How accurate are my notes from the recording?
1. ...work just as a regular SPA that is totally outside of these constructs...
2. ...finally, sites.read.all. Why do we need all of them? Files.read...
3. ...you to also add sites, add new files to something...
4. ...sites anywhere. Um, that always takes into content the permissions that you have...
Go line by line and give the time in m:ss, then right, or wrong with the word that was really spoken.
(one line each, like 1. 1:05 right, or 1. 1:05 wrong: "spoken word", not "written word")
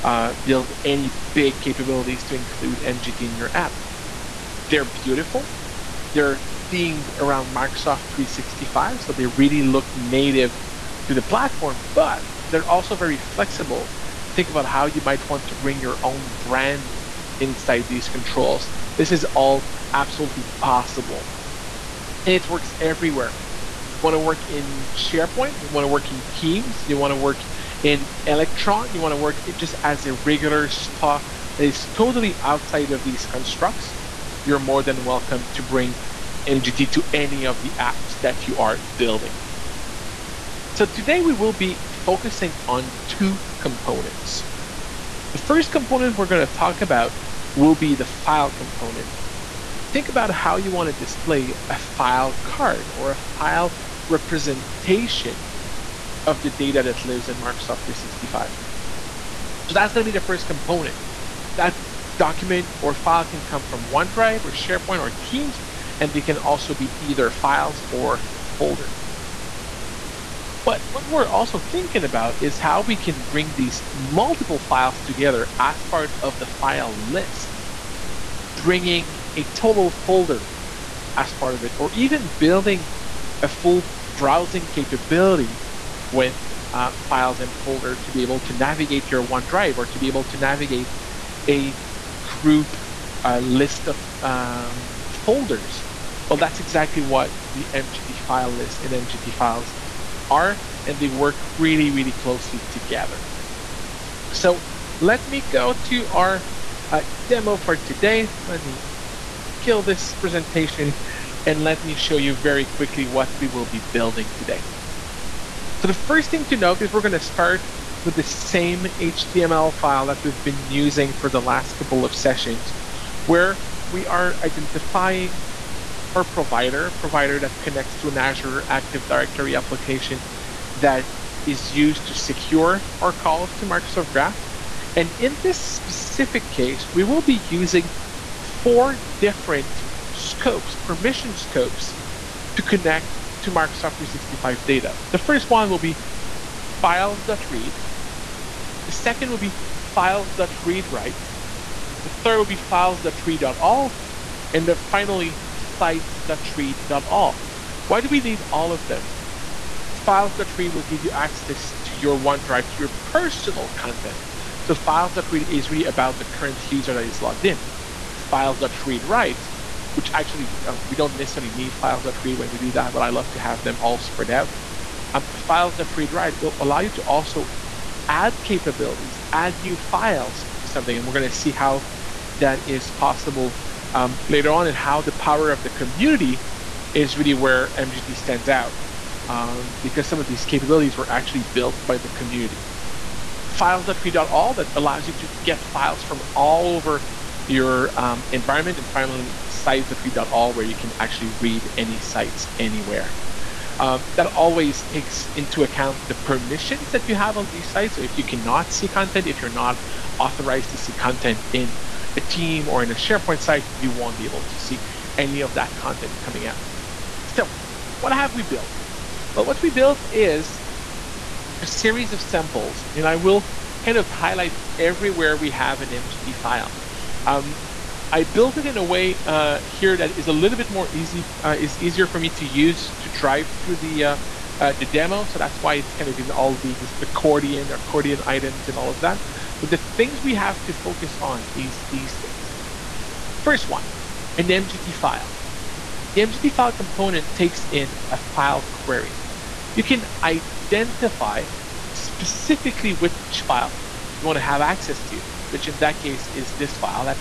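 1. 0:29 right
2. 2:34 right
3. 2:56 wrong: "capabilities", not "sites"
4. 3:21 wrong: "account", not "content".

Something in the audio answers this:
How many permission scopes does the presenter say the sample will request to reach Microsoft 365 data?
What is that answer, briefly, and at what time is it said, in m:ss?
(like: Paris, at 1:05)
4, at 2:18.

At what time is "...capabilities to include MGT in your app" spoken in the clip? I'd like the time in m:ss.
0:01.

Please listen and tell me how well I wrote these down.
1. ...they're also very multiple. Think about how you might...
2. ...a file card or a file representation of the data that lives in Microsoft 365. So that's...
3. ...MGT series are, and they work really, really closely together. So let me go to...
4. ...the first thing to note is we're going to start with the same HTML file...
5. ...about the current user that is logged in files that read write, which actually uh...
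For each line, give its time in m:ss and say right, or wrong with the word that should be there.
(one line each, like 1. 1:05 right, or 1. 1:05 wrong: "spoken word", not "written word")
1. 0:12 wrong: "flexible", not "multiple"
2. 0:51 right
3. 1:38 wrong: "files", not "series"
4. 1:55 right
5. 2:45 right.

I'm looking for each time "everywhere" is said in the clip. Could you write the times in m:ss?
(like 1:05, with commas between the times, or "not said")
0:22, 3:44.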